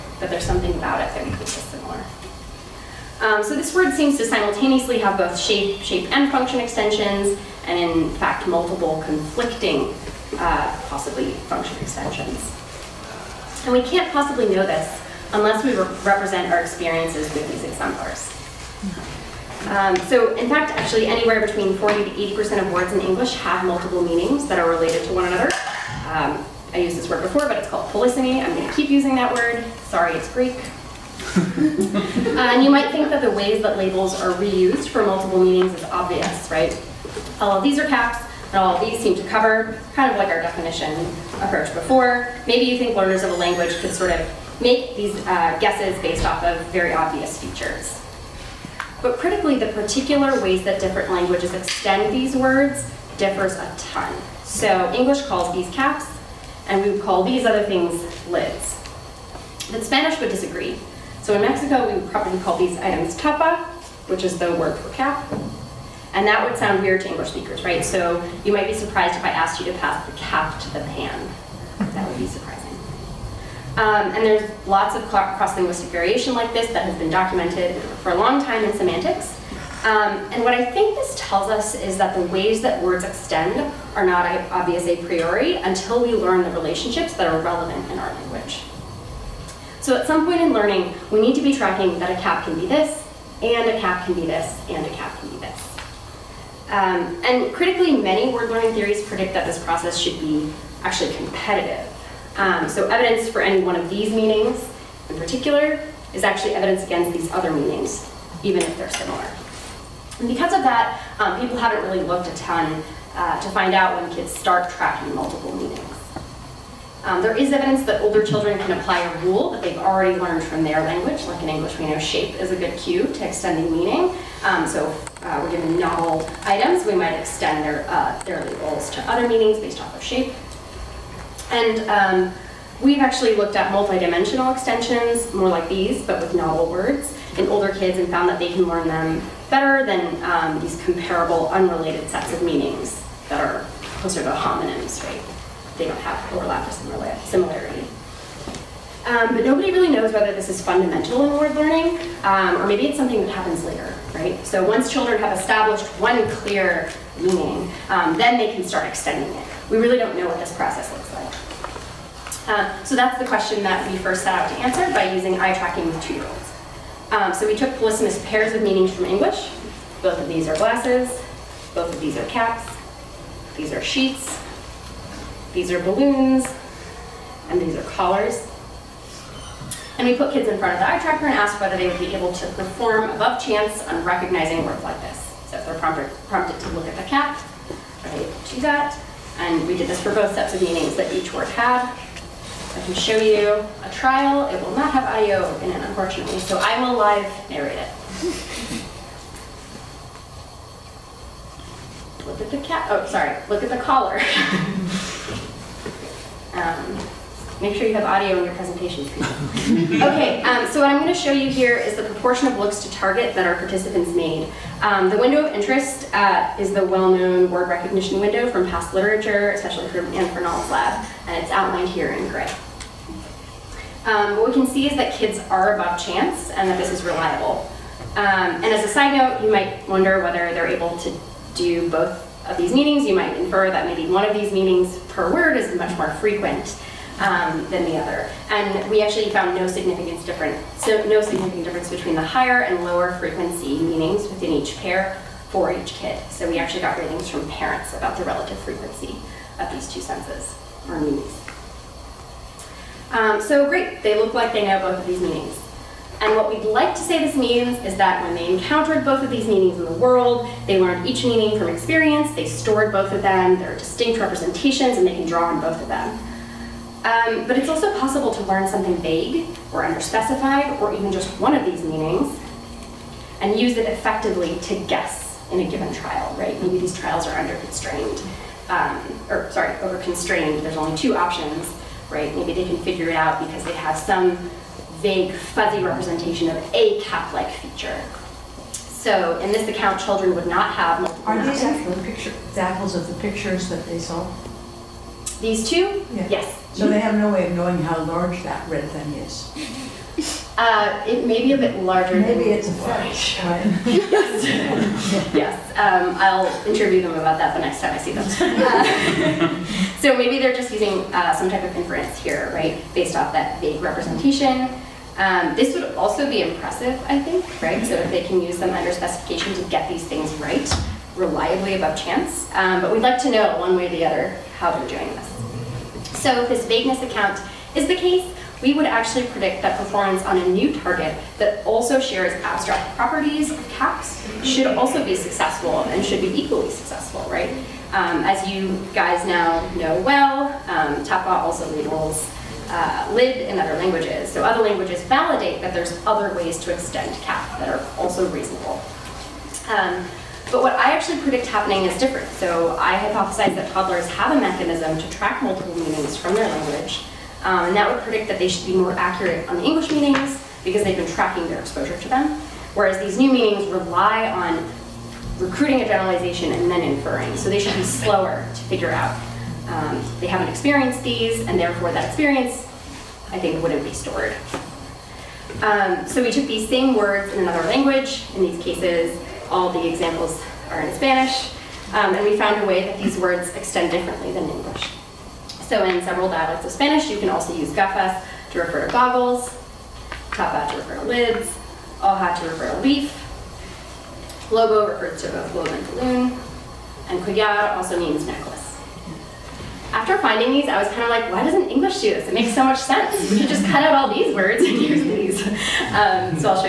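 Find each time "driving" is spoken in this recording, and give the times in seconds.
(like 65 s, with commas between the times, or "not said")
not said.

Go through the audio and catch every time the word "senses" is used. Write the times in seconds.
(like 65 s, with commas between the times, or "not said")
250 s, 402 s.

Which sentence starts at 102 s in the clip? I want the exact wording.
Um, so evidence for any one of these meanings in particular is actually evidence against these other meanings, even if they're similar.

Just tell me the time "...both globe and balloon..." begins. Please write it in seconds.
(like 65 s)
395 s.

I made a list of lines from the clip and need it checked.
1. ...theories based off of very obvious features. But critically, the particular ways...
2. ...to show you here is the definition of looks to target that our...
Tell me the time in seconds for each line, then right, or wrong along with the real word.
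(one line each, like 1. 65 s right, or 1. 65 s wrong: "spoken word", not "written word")
1. 45 s wrong: "guesses", not "theories"
2. 211 s wrong: "proportion", not "definition".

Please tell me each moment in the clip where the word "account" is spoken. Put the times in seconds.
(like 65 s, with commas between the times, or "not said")
289 s, 327 s.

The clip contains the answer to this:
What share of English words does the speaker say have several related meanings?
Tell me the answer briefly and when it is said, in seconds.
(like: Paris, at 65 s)
40 to 80%, at 21 s.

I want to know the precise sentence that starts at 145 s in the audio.
they don't have overlap or similar similarity.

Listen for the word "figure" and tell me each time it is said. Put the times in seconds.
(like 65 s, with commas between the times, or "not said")
282 s, 368 s.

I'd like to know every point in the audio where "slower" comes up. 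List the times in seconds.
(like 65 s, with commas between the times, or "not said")
367 s.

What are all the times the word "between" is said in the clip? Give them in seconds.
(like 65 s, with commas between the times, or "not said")
21 s, 241 s.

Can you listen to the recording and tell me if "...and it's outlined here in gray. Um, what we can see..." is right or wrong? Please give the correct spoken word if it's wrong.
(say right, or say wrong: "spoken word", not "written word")
right.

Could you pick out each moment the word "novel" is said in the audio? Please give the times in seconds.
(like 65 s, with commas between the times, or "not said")
125 s, 136 s.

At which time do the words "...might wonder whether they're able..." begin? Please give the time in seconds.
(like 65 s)
229 s.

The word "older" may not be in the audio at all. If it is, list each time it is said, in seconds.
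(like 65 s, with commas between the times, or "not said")
118 s, 137 s.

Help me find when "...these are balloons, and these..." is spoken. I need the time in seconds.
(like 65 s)
175 s.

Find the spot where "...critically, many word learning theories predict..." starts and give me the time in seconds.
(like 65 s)
97 s.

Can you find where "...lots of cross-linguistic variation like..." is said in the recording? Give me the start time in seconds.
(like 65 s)
74 s.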